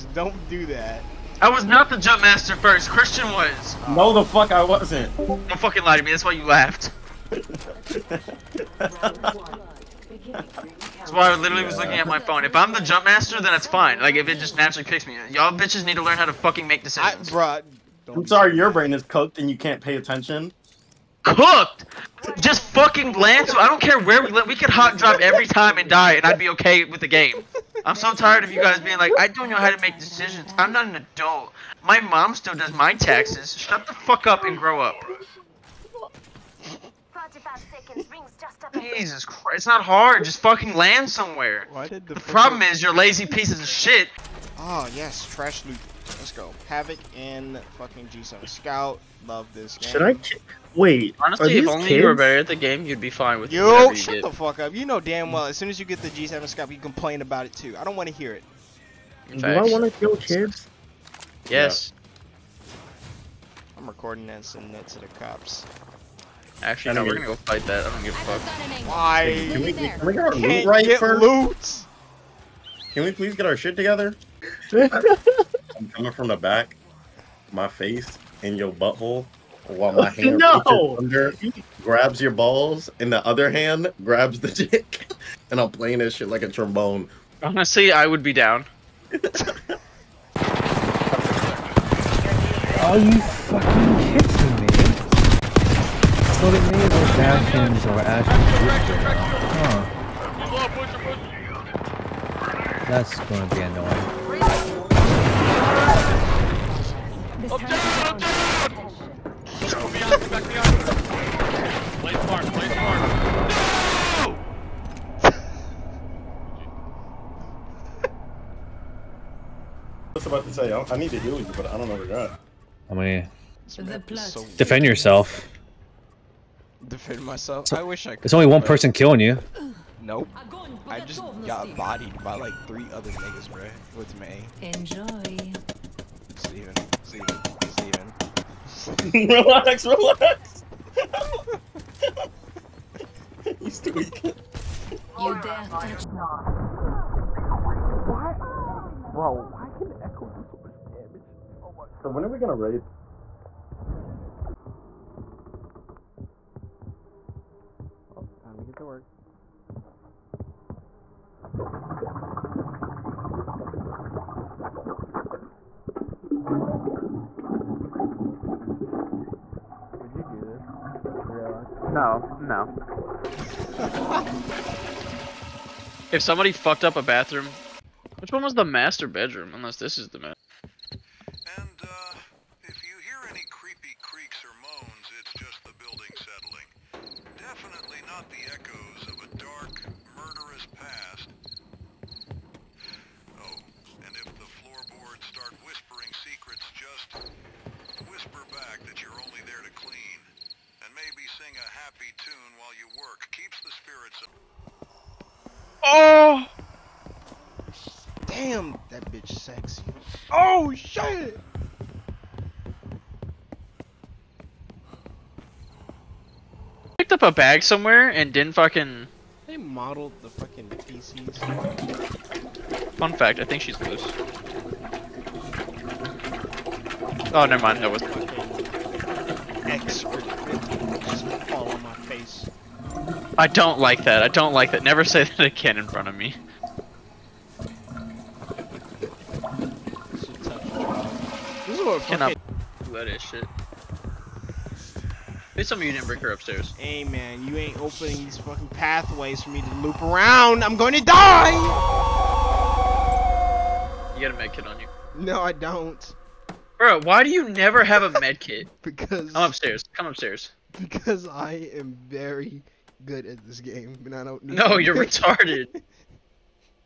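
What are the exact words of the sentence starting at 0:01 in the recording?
I was not the jump master first.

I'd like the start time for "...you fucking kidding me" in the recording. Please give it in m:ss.
1:32.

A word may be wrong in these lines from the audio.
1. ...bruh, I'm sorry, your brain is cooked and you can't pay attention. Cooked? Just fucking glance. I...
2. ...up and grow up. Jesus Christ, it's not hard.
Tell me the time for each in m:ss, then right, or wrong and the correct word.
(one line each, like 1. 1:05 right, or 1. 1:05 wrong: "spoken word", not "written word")
1. 0:17 right
2. 0:34 right.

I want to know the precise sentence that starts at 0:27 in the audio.
I'm so tired of you guys being like, I don't know how to make decisions.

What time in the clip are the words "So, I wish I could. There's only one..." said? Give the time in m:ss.
2:07.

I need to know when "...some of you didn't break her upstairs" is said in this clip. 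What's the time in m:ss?
4:05.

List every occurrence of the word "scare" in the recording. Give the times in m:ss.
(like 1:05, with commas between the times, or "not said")
not said.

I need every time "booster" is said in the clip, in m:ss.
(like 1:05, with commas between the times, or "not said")
not said.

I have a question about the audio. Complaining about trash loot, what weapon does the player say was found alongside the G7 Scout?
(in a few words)
Havoc.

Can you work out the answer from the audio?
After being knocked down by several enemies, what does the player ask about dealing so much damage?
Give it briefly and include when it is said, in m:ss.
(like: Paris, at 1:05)
Echo, at 2:30.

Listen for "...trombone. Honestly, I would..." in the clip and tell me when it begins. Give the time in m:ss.
1:26.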